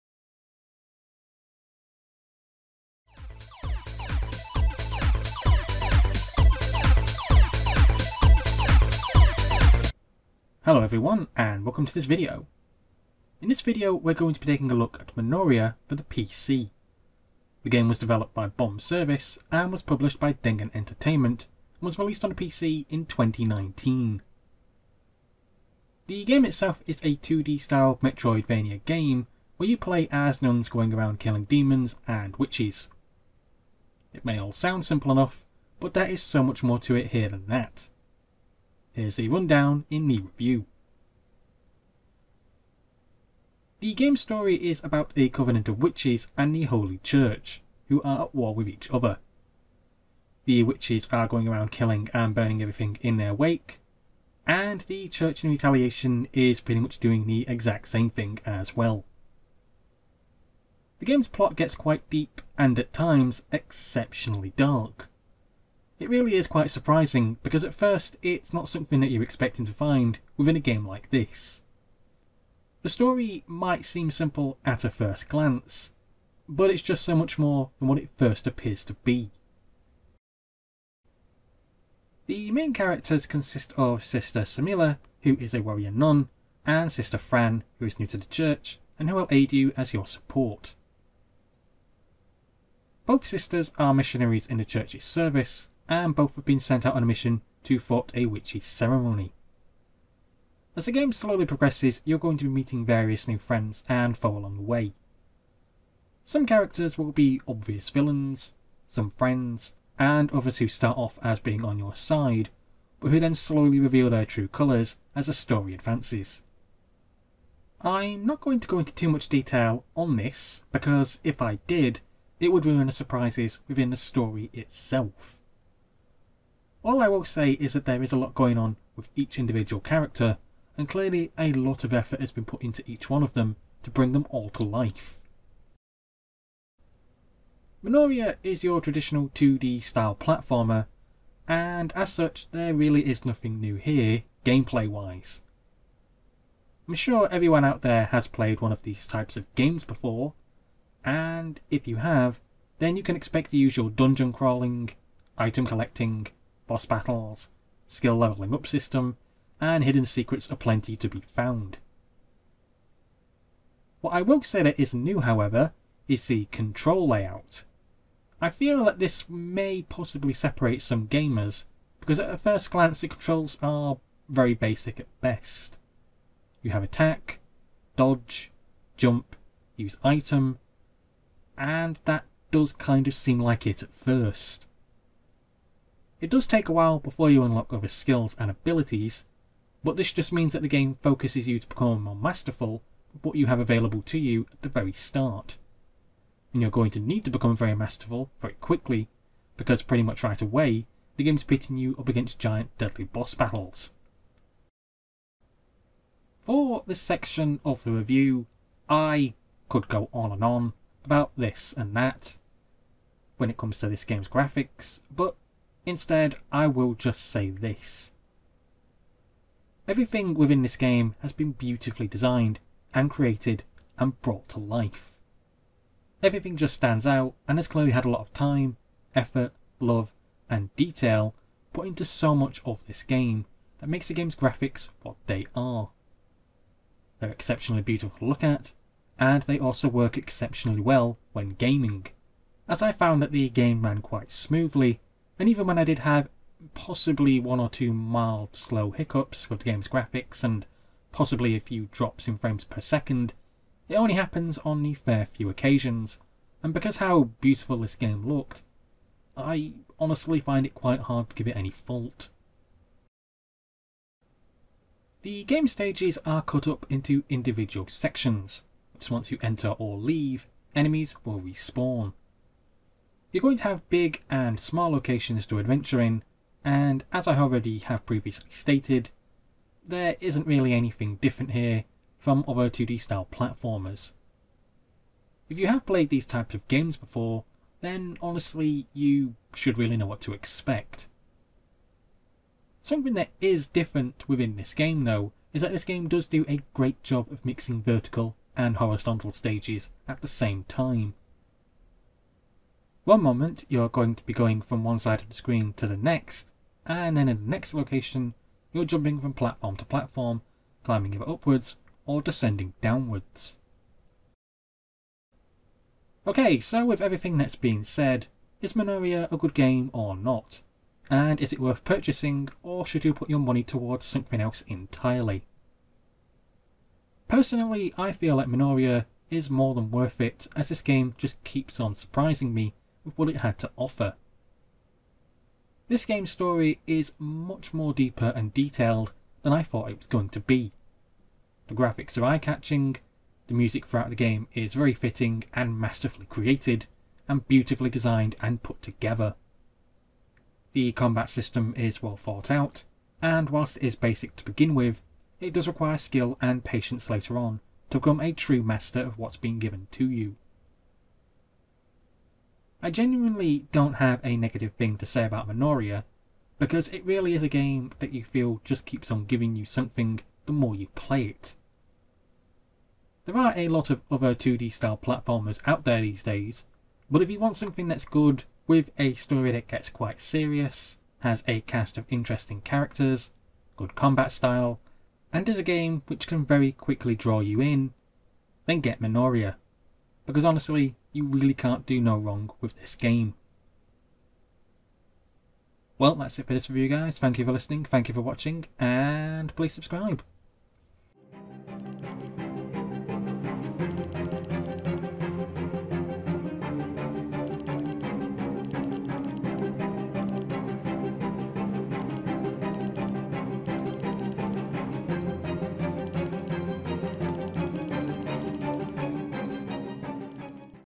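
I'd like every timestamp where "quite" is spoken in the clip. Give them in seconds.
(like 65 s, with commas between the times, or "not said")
61 s, 66 s, 244 s, 260 s, 379 s.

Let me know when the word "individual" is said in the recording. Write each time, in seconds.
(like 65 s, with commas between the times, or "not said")
129 s, 267 s.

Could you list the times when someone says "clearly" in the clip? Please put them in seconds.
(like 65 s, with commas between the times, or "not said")
130 s, 227 s.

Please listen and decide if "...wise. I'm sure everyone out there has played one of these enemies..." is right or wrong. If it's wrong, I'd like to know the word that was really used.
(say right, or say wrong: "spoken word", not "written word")
wrong: "types", not "enemies".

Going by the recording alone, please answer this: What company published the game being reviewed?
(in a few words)
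DANGEN Entertainment.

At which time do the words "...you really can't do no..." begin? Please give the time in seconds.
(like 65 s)
391 s.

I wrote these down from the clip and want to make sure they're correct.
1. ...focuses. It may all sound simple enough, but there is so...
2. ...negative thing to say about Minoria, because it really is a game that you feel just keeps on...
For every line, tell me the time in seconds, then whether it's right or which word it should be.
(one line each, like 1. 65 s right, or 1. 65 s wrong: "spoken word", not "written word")
1. 32 s wrong: "witches", not "focuses"
2. 364 s right.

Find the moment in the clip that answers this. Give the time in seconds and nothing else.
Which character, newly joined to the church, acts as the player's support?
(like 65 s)
86 s.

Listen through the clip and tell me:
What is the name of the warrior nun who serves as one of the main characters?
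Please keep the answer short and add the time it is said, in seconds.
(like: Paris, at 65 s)
Sister Semilla, at 84 s.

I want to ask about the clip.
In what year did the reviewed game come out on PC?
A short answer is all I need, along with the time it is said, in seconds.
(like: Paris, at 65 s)
2019, at 23 s.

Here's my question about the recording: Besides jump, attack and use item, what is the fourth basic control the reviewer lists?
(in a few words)
Dodge.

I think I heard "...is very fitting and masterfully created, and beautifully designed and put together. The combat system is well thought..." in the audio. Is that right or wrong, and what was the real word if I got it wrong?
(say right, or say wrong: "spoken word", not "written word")
right.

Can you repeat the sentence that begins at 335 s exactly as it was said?
This game's story is much more deeper and detailed than I thought it was going to be.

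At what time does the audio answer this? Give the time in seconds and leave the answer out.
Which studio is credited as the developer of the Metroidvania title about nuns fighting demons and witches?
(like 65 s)
18 s.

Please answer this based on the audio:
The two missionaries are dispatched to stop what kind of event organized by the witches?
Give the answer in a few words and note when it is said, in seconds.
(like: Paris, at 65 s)
A witchy ceremony, at 98 s.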